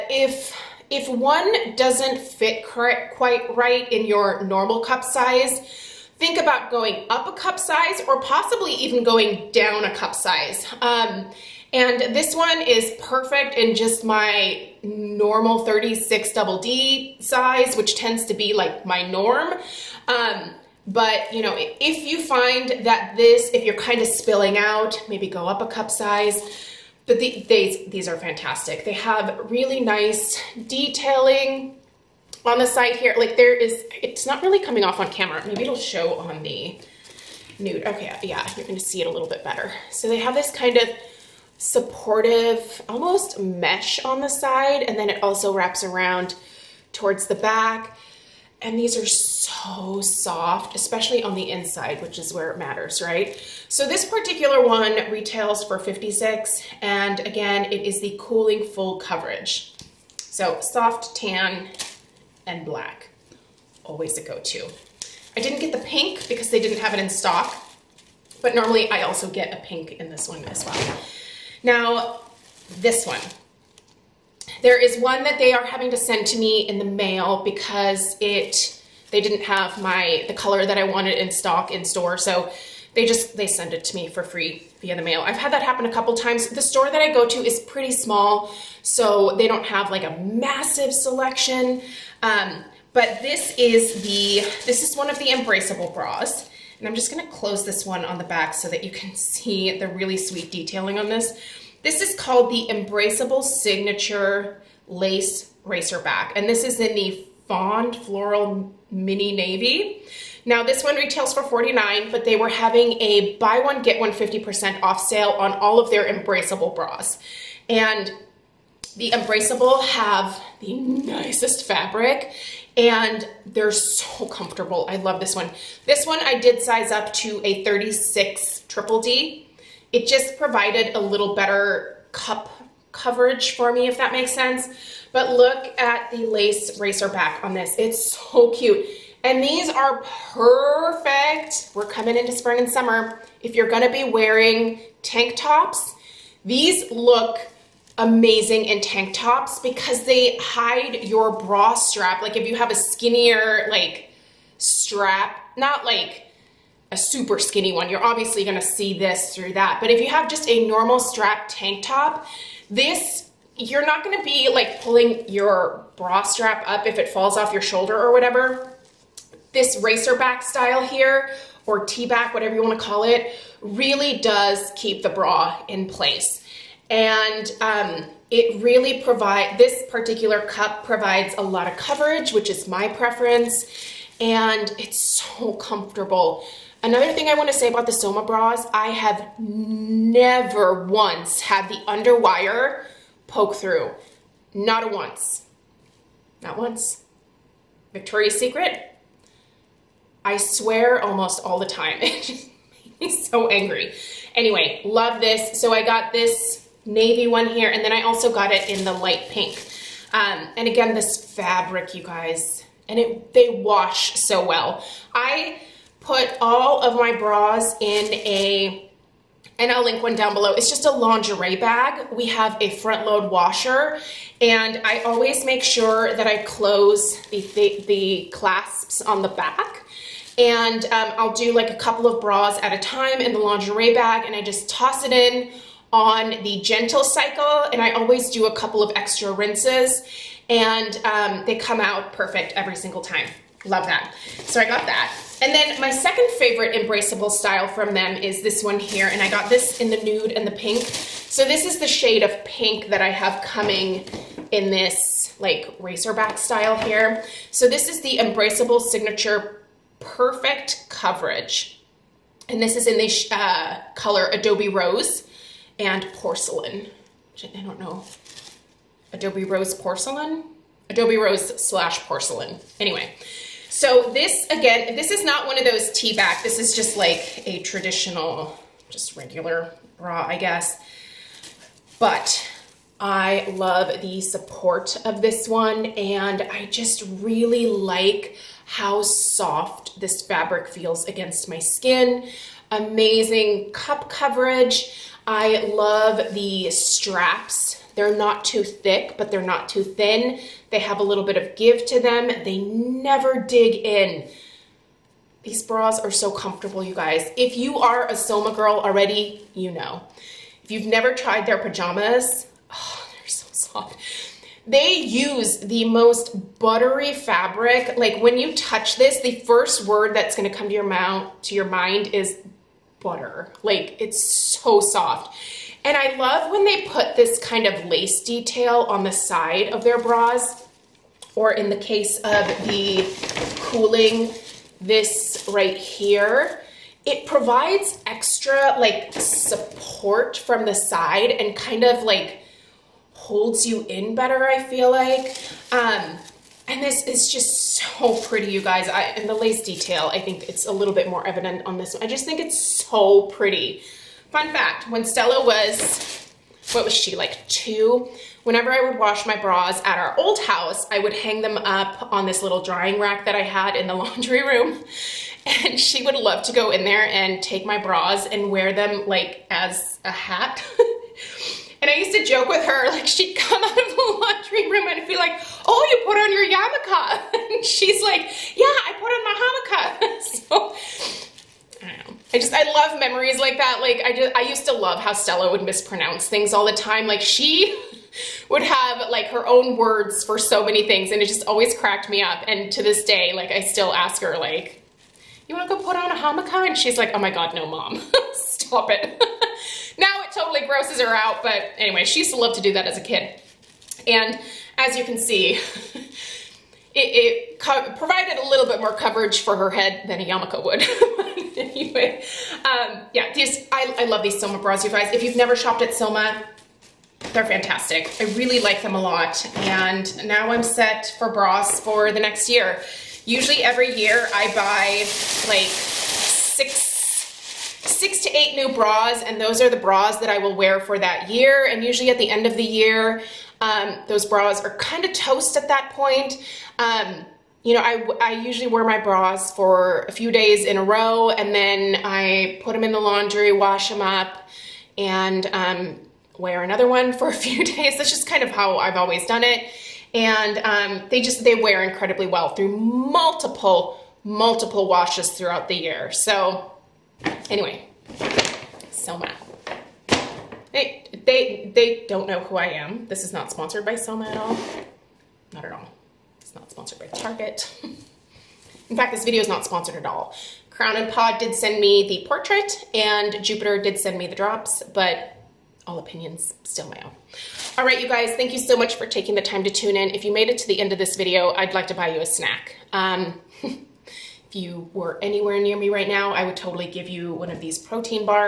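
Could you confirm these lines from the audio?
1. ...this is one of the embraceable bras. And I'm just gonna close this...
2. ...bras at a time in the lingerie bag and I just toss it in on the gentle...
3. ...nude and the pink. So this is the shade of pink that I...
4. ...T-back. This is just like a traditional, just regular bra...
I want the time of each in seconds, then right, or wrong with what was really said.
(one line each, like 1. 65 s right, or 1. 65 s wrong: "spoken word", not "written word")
1. 94 s right
2. 232 s right
3. 250 s right
4. 275 s right.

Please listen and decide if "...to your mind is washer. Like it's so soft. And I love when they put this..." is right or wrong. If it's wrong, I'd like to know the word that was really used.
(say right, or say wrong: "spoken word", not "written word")
wrong: "butter", not "washer".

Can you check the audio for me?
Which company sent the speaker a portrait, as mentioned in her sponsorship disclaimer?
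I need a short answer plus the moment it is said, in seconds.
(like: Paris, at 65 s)
Crown and Paw, at 470 s.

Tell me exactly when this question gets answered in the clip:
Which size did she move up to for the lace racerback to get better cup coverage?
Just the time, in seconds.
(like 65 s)
127 s.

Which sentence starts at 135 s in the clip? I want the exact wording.
But look at the lace racer back on this.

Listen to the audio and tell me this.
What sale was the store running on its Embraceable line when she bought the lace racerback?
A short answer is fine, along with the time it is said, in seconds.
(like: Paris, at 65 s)
Buy one get one 50% off, at 113 s.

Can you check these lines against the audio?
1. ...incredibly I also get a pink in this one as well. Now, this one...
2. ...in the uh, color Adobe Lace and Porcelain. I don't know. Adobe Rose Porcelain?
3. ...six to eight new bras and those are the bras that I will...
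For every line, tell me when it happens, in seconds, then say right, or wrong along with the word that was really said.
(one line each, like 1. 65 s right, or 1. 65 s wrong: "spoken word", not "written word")
1. 68 s wrong: "normally", not "incredibly"
2. 262 s wrong: "Rose", not "Lace"
3. 427 s right.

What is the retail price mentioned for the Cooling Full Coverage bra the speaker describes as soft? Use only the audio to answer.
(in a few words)
56.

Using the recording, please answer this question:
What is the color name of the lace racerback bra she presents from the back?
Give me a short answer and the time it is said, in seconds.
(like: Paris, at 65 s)
Fond Floral Mini Navy, at 107 s.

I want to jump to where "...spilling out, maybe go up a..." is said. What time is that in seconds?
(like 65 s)
24 s.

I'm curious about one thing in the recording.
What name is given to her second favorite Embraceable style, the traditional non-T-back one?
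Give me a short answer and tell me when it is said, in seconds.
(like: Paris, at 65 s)
Embraceable Signature Perfect Coverage, at 258 s.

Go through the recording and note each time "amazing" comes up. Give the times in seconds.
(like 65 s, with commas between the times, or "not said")
147 s, 292 s.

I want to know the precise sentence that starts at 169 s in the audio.
This racer back style here, or T-back, whatever you wanna call it, really does keep the bra in place.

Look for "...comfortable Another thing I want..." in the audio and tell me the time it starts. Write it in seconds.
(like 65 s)
185 s.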